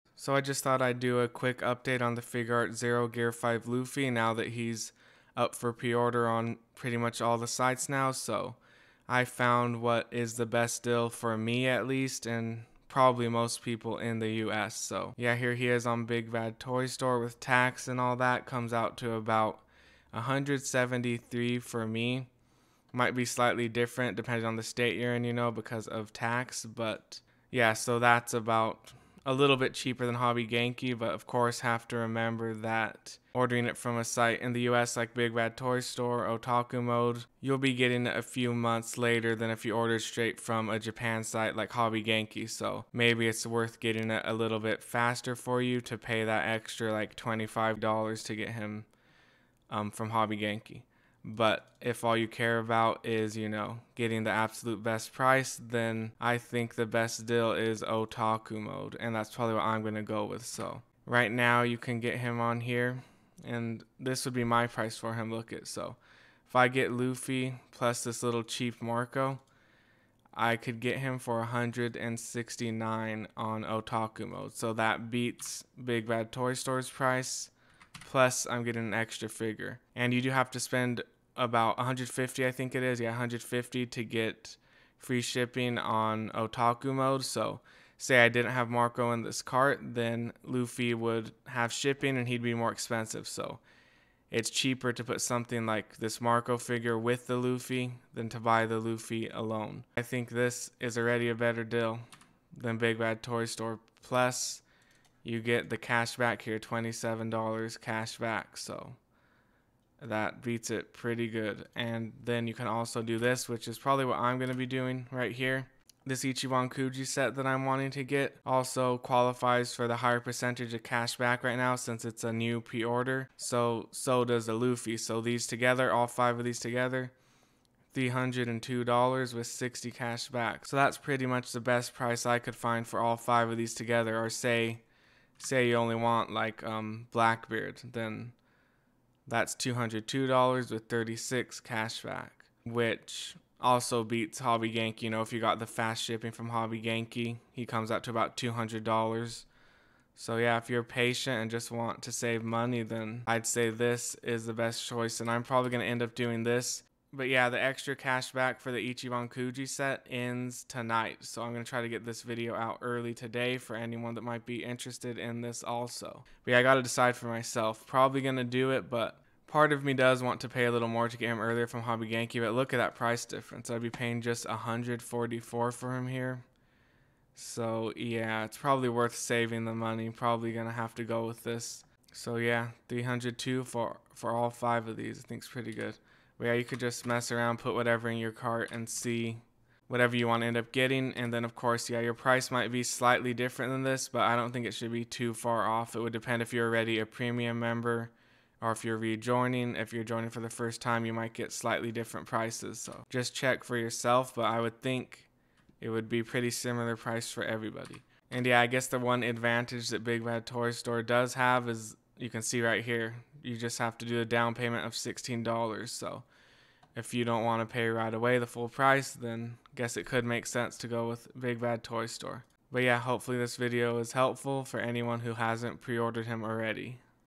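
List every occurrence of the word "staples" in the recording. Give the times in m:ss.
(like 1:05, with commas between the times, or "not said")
not said.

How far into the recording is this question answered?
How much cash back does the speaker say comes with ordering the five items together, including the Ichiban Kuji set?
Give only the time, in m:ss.
2:09.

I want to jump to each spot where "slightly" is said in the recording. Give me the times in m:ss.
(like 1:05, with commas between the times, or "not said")
0:23, 3:12, 3:21.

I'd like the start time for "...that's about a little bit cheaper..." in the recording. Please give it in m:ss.
0:27.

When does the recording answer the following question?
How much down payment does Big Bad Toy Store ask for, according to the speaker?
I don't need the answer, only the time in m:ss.
3:34.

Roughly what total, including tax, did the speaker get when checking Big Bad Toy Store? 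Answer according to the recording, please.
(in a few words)
$173.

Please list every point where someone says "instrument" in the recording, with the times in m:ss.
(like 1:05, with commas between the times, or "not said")
not said.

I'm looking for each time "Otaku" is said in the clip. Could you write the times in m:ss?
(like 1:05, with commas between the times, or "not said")
0:36, 0:57, 1:13, 1:26.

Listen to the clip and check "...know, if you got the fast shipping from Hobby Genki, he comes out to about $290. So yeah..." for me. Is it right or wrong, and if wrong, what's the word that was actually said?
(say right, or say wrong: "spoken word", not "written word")
wrong: "200", not "290".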